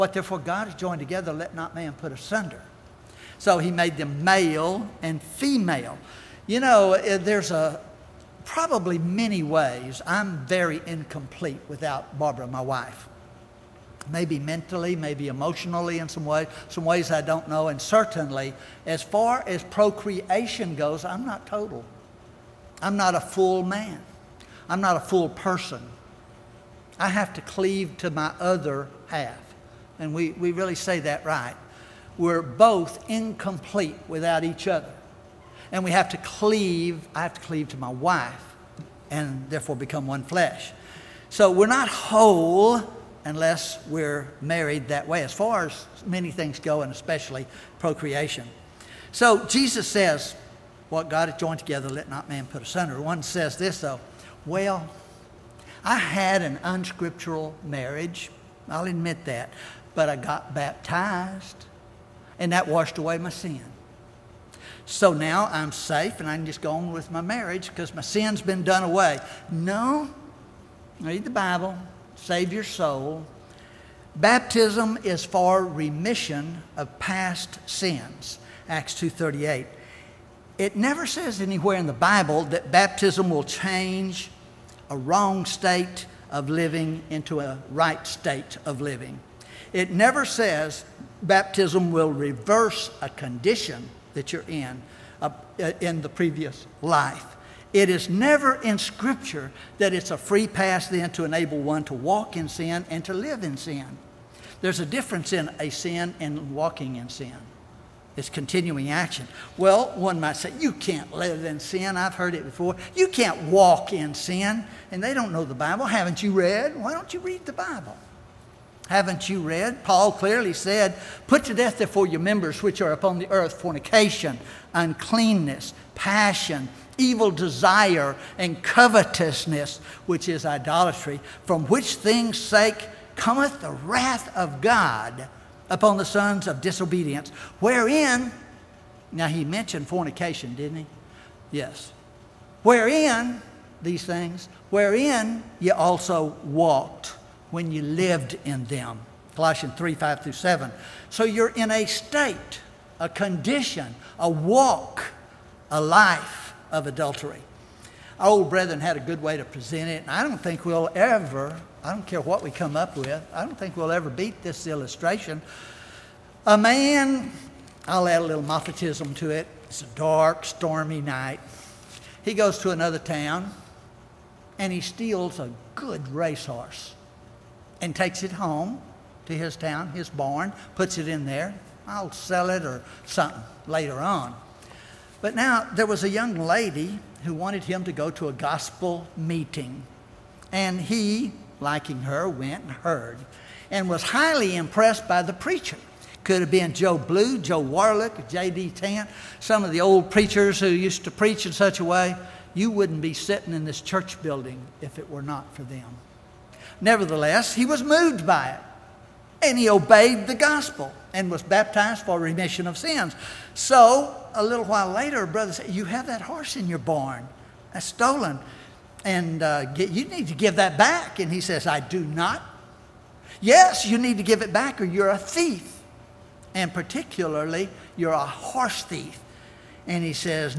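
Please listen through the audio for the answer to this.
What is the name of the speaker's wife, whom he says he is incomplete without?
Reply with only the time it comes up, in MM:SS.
00:12.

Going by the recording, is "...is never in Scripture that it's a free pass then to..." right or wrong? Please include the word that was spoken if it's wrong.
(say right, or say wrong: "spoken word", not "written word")
right.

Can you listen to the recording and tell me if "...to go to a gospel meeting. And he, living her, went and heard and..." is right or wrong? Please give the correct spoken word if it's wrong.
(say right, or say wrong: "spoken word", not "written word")
wrong: "liking", not "living".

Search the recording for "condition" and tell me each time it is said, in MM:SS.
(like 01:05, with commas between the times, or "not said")
01:33, 02:33.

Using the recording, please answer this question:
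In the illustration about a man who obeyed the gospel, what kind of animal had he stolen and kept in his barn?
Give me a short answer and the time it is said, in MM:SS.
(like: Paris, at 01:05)
racehorse, at 02:56.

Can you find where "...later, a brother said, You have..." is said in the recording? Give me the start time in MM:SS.
03:34.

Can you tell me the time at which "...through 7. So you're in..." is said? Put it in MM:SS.
02:30.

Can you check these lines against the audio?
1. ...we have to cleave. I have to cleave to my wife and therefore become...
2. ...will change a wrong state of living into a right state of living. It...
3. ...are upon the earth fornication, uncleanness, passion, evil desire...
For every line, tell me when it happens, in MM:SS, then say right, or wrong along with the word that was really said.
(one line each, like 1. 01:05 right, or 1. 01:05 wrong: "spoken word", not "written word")
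1. 00:35 right
2. 01:23 right
3. 02:02 right.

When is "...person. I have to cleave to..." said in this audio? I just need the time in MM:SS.
00:25.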